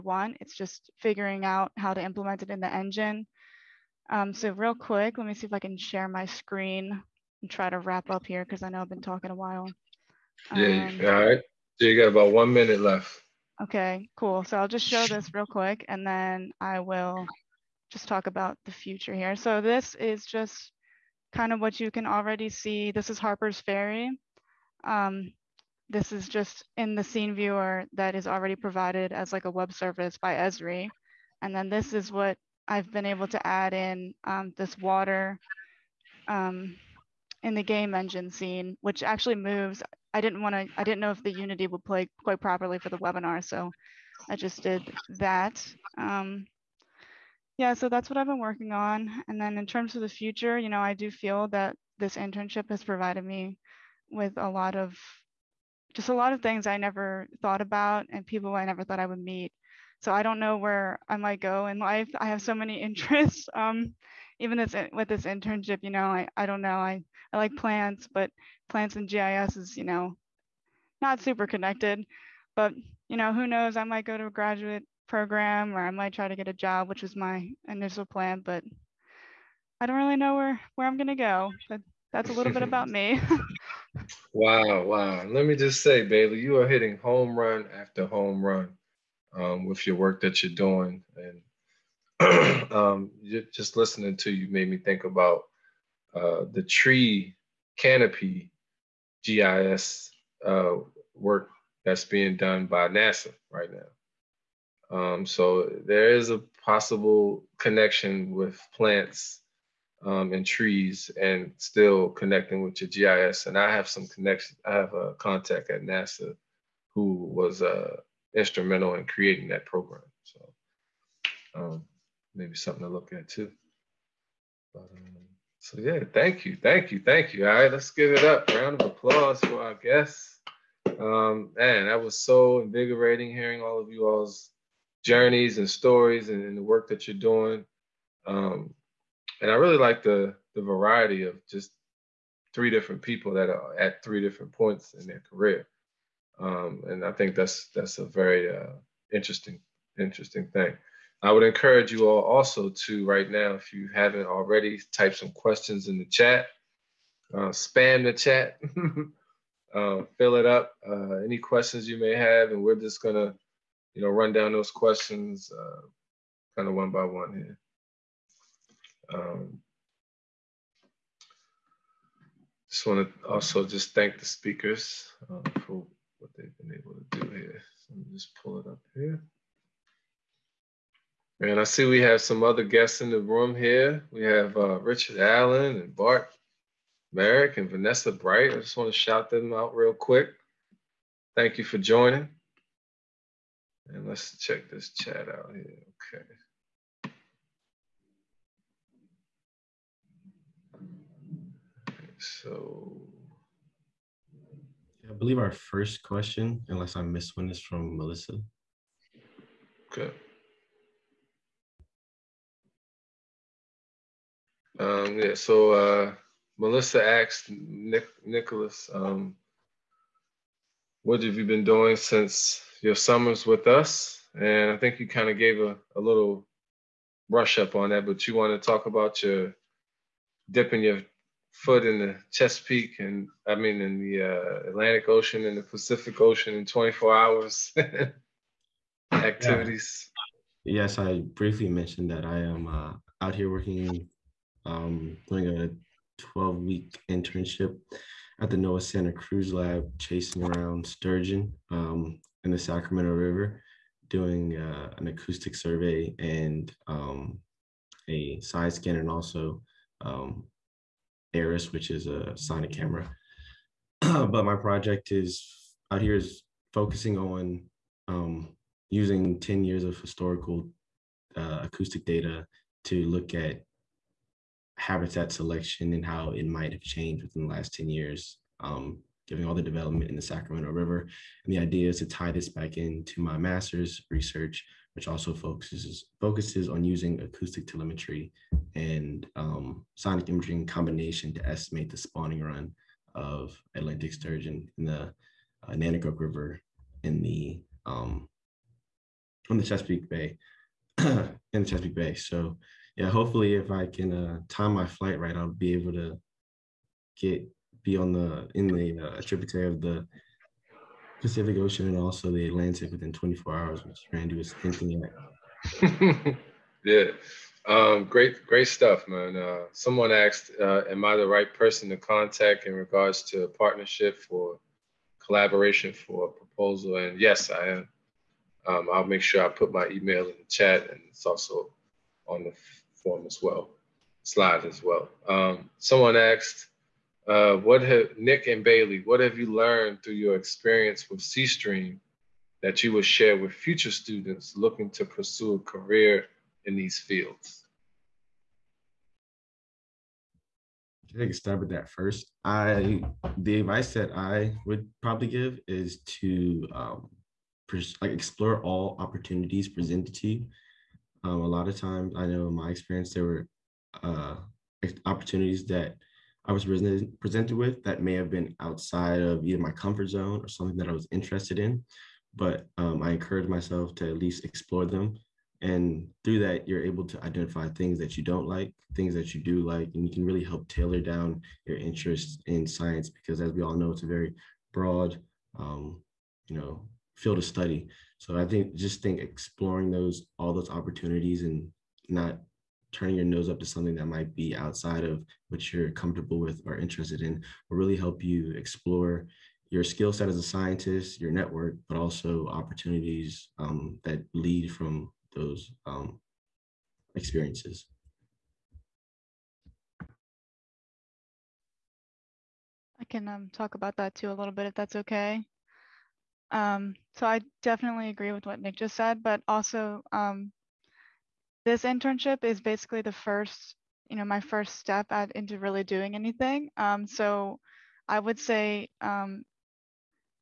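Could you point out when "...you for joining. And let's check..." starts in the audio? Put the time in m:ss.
3:11.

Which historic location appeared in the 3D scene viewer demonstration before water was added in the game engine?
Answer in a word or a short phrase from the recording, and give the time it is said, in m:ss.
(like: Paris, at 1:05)
Harper's Ferry, at 0:23.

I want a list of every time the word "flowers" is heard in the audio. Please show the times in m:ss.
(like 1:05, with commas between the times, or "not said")
not said.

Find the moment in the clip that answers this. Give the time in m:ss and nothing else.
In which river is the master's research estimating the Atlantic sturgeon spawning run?
4:55.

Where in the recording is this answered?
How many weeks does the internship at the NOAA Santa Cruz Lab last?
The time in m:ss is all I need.
4:06.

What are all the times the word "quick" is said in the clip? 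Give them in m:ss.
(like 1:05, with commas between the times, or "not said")
0:04, 0:15, 3:09.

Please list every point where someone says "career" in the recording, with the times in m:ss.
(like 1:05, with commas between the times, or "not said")
2:25, 5:45.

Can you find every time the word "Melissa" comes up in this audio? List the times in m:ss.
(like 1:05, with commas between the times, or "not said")
3:27, 3:36.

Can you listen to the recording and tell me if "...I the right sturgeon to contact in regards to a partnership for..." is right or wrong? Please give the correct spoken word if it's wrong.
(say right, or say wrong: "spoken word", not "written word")
wrong: "person", not "sturgeon".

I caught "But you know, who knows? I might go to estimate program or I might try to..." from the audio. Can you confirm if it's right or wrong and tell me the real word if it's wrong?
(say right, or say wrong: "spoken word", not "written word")
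wrong: "graduate", not "estimate".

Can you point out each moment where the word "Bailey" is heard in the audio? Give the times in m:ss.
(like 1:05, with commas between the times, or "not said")
1:26, 5:38.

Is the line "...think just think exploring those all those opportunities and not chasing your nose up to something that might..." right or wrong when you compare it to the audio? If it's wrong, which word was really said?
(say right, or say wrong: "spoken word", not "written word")
wrong: "turning", not "chasing".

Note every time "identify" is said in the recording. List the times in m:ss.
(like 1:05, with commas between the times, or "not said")
6:17.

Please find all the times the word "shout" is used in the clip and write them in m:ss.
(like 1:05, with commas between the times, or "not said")
3:08.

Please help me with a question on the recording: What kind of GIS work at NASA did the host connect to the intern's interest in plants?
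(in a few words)
tree canopy.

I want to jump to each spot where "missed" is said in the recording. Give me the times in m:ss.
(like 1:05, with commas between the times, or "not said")
3:27.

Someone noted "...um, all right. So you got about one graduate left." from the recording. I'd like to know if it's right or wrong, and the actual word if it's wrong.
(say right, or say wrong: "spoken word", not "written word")
wrong: "minute", not "graduate".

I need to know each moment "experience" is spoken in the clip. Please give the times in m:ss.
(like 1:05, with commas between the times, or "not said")
5:40, 6:02, 6:47.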